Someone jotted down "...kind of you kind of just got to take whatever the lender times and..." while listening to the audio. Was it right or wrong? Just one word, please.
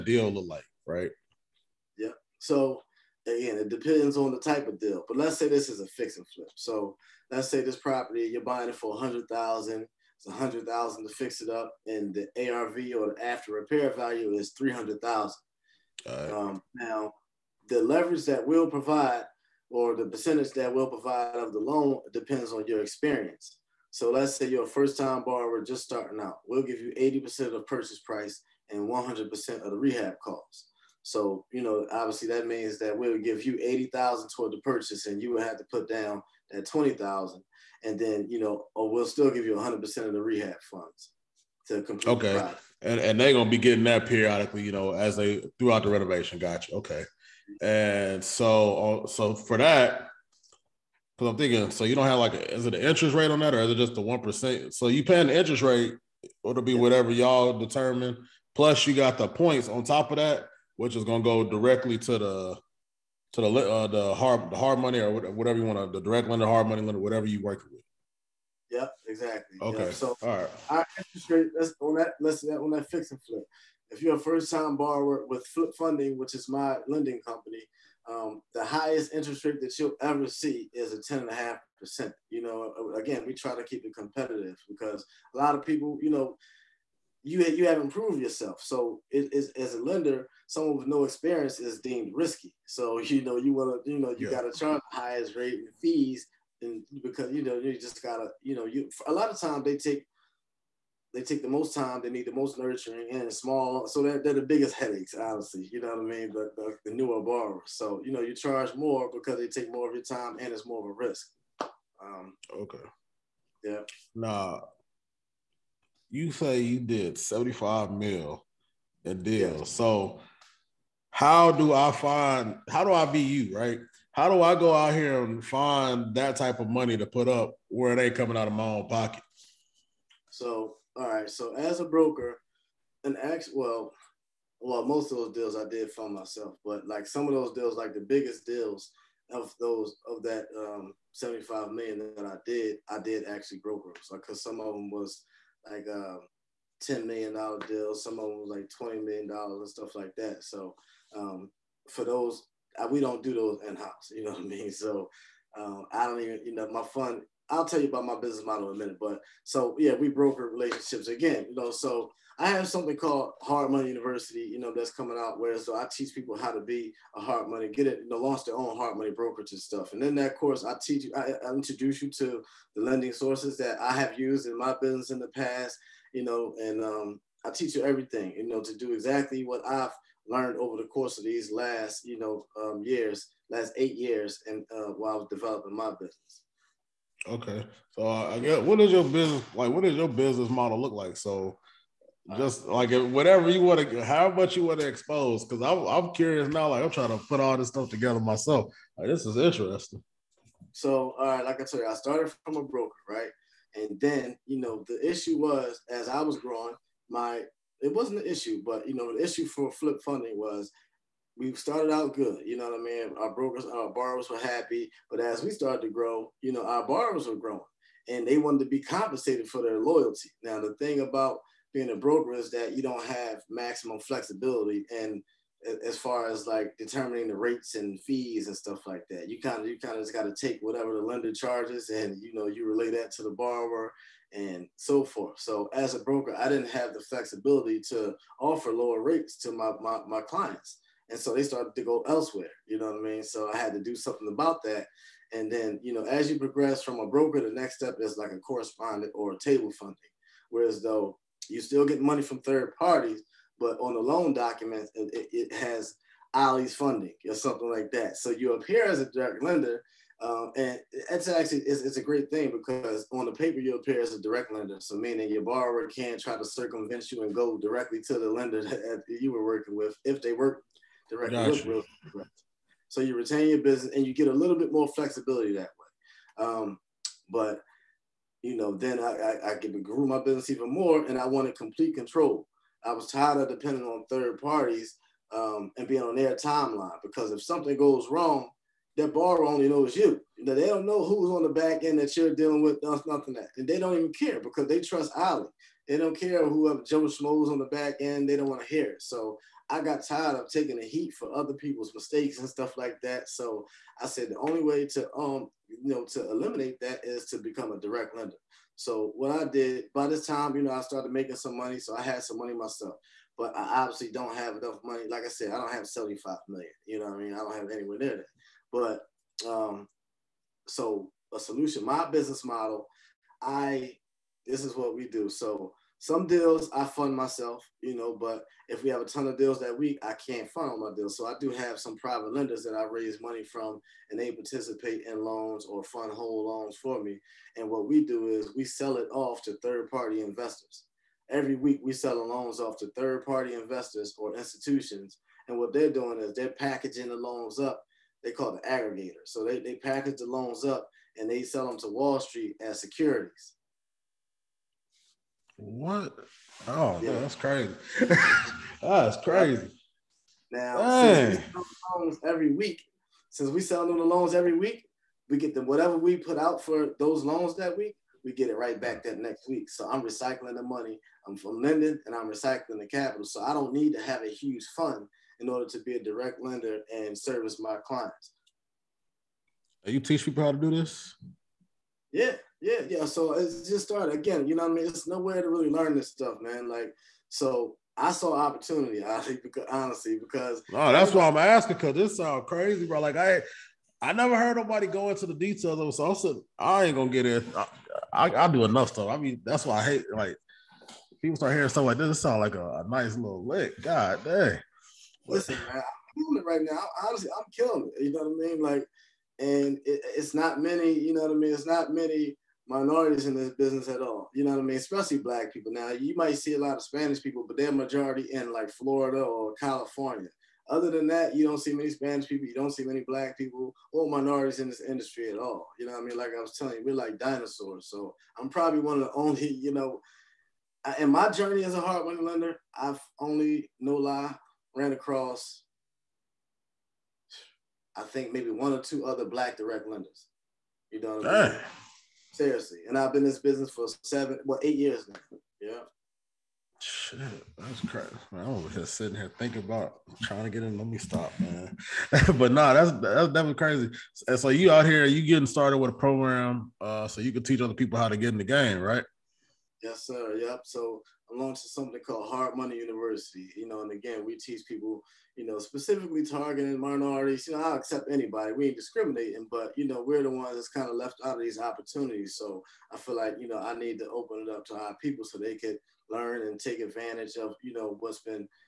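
wrong.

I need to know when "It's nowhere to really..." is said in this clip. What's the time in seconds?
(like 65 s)
384 s.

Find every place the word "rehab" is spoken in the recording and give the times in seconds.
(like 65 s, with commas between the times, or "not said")
29 s, 40 s.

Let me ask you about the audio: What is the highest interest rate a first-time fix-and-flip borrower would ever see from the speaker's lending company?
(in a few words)
10.5%.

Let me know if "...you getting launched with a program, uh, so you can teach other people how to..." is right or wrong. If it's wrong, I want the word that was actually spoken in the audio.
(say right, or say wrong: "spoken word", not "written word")
wrong: "started", not "launched".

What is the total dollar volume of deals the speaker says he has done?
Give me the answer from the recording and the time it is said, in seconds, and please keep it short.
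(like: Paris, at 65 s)
$75 million, at 117 s.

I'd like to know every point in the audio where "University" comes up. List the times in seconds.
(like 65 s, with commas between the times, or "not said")
163 s, 462 s.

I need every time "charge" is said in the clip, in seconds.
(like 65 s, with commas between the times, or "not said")
94 s, 108 s, 231 s.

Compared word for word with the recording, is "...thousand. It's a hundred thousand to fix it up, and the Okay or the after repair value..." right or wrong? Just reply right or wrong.
wrong.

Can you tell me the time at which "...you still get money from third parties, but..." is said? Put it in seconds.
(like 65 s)
251 s.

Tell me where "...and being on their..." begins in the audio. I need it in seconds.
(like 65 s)
285 s.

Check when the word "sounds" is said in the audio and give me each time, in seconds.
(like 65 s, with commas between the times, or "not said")
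392 s, 402 s.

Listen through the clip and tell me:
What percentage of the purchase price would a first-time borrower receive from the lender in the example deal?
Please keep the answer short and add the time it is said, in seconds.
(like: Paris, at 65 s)
80%, at 26 s.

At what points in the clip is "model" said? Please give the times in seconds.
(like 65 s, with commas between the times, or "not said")
158 s, 190 s, 322 s.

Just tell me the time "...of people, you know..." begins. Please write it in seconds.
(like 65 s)
85 s.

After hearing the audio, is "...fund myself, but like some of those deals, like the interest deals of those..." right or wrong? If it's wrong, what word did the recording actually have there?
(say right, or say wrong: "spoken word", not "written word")
wrong: "biggest", not "interest".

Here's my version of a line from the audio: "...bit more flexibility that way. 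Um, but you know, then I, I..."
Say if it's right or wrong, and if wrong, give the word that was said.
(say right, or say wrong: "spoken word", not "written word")
right.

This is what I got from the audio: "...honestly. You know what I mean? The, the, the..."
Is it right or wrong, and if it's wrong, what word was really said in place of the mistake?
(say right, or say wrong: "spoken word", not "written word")
right.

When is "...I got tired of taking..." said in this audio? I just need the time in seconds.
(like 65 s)
299 s.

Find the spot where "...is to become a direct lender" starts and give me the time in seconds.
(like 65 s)
307 s.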